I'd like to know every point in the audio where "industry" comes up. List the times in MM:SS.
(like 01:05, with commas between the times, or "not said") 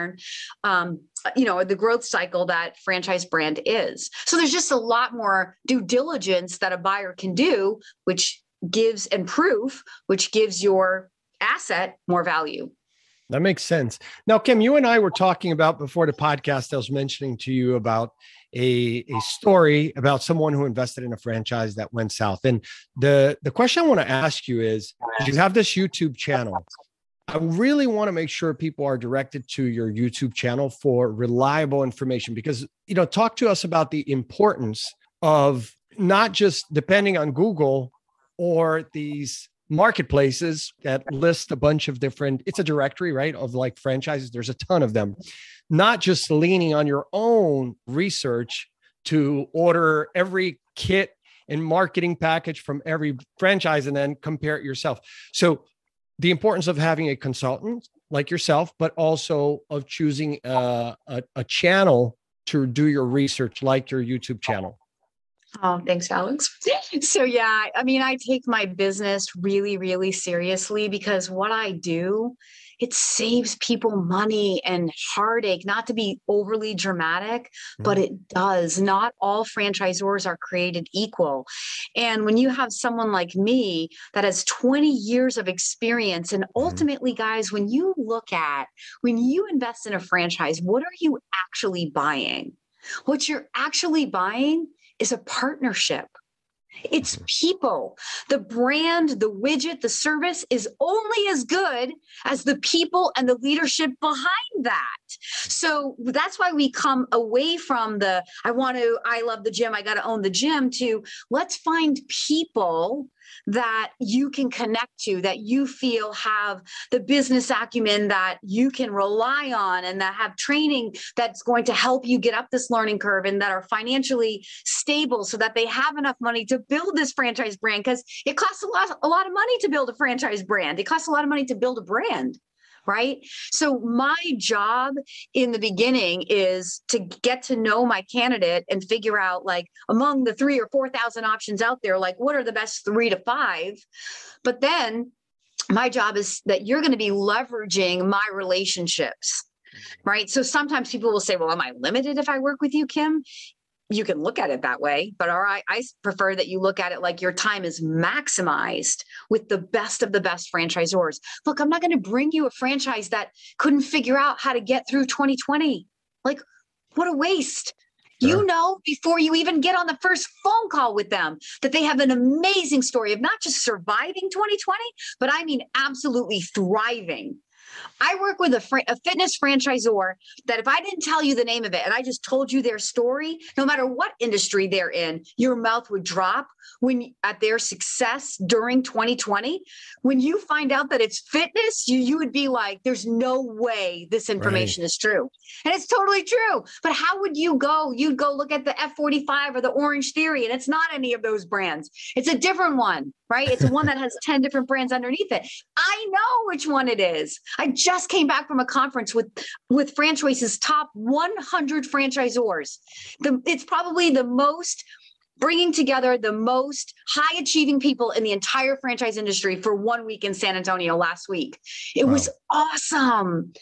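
03:04, 03:39.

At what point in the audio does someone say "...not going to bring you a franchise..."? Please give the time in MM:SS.
02:41.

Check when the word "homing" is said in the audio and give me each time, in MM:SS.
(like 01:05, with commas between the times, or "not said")
not said.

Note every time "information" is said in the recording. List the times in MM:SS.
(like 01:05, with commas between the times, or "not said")
00:31, 03:14.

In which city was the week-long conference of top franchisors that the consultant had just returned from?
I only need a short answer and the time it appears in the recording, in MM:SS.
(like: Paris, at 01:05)
San Antonio, at 03:40.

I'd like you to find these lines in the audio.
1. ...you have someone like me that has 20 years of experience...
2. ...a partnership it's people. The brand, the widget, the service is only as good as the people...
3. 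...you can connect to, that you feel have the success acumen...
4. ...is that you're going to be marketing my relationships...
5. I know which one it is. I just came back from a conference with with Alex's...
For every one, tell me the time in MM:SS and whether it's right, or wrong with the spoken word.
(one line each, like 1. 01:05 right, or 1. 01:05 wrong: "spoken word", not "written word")
1. 01:22 right
2. 01:35 right
3. 01:54 wrong: "business", not "success"
4. 02:26 wrong: "leveraging", not "marketing"
5. 03:25 wrong: "Franchoice", not "Alex".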